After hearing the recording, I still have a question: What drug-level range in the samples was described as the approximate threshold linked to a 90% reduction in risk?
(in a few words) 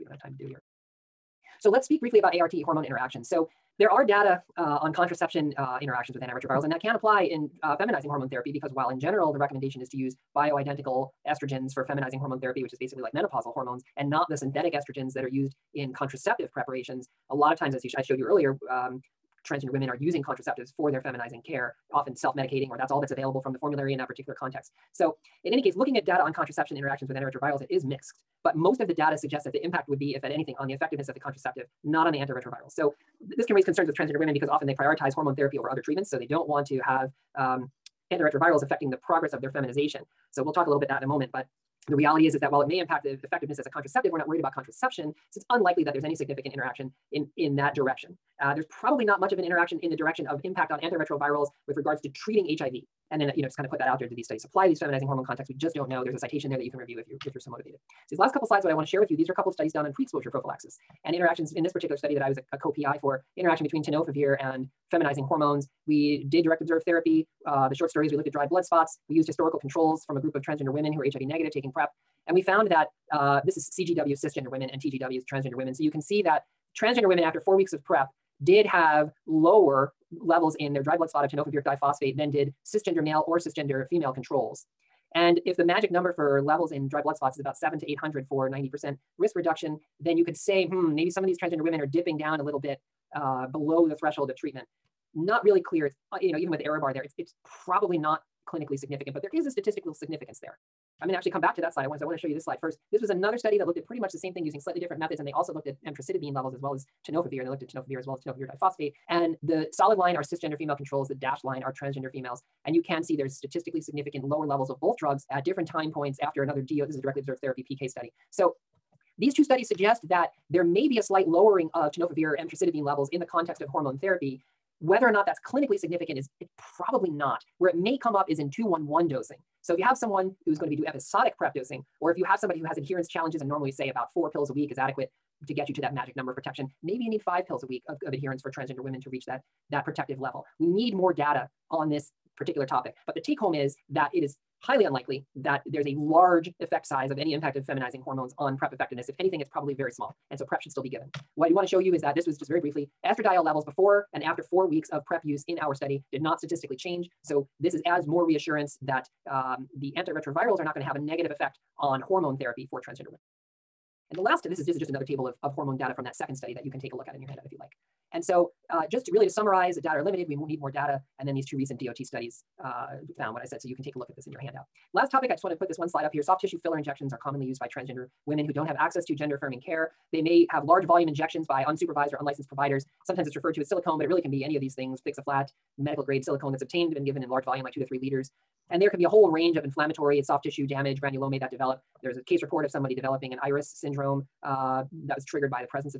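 700 to 800.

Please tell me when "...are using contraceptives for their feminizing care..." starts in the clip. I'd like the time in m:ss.
0:19.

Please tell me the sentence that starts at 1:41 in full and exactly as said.
I want so I want to show you this slide first.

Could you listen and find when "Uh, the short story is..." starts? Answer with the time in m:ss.
1:07.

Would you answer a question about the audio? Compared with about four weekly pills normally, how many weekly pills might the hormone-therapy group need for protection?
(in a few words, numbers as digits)
5.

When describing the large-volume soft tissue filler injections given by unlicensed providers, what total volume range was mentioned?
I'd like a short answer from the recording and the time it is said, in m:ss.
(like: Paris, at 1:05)
2 to 3 liters, at 3:07.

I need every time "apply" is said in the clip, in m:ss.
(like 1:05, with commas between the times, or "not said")
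0:06, 0:54.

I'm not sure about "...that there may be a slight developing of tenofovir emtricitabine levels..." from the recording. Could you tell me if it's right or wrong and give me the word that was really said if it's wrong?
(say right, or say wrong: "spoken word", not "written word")
wrong: "lowering", not "developing".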